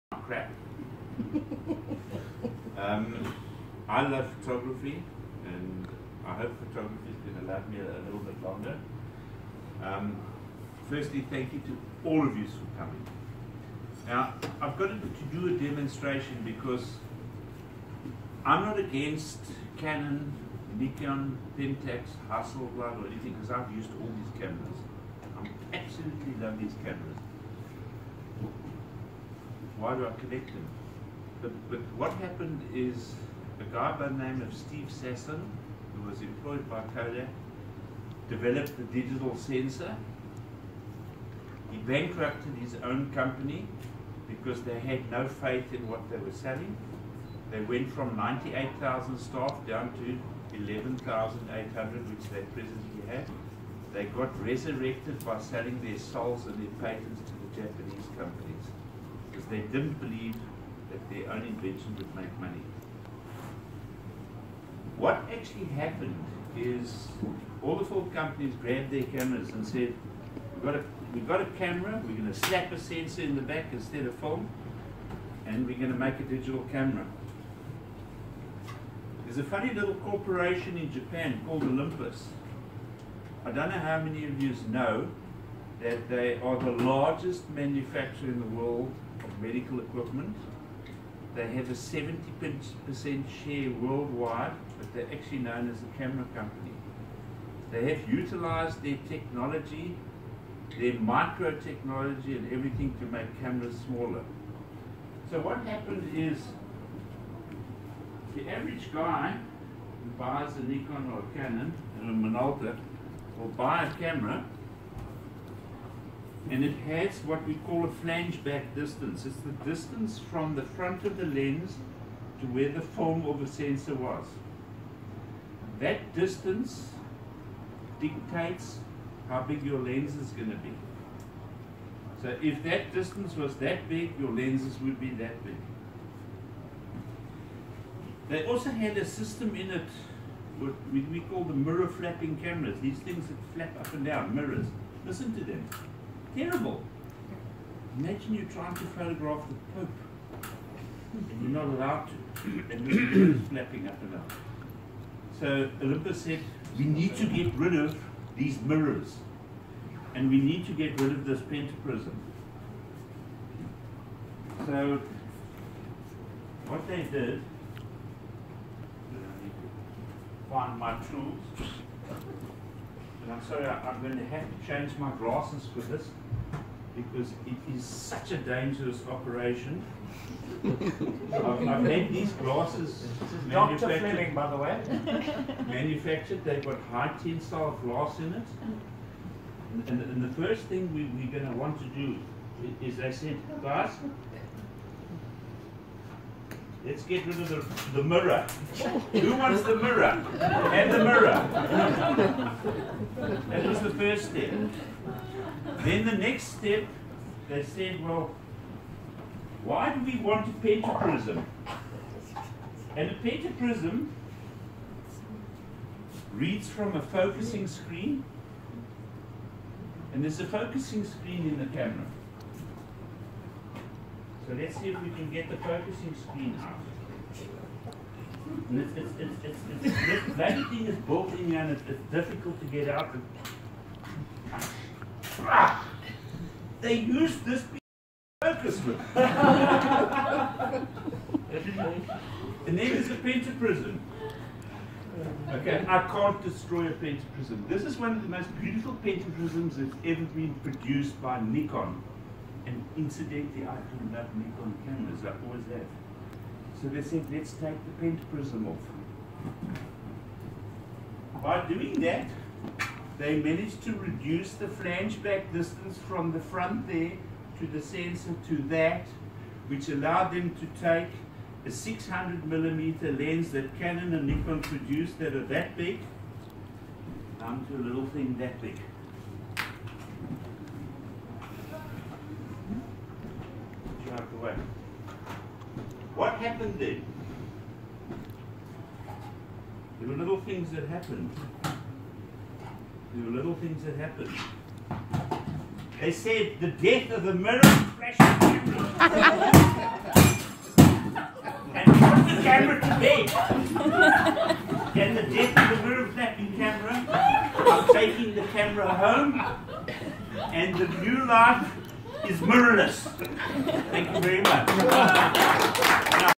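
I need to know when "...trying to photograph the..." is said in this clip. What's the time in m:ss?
2:28.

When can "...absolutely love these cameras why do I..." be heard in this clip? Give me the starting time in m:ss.
0:25.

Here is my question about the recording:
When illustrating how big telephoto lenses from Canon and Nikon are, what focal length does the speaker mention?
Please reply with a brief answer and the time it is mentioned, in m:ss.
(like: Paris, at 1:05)
600 millimeter, at 4:31.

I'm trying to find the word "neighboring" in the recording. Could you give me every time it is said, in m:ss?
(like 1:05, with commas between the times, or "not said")
not said.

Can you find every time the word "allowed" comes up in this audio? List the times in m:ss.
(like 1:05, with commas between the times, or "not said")
2:31, 4:29.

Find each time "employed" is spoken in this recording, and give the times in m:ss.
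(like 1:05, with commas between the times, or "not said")
0:36.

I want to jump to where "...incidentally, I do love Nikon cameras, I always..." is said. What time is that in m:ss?
4:12.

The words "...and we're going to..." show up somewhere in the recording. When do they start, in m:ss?
1:15.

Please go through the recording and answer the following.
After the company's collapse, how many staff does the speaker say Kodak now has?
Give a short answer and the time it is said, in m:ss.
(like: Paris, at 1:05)
11,800, at 0:50.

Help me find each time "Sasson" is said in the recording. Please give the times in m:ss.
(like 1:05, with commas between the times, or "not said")
0:34.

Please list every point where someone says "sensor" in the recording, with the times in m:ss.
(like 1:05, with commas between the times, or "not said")
0:39, 1:12, 2:03, 4:27.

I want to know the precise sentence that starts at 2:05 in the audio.
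That distance dictates how big your lens is going to be.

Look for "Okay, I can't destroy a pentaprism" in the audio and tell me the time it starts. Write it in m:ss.
4:05.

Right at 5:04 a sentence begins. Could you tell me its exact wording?
And the death of the mirror flapping camera, I'm taking the camera home, and the new life is mirrorless.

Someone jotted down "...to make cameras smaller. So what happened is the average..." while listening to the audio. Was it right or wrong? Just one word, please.
right.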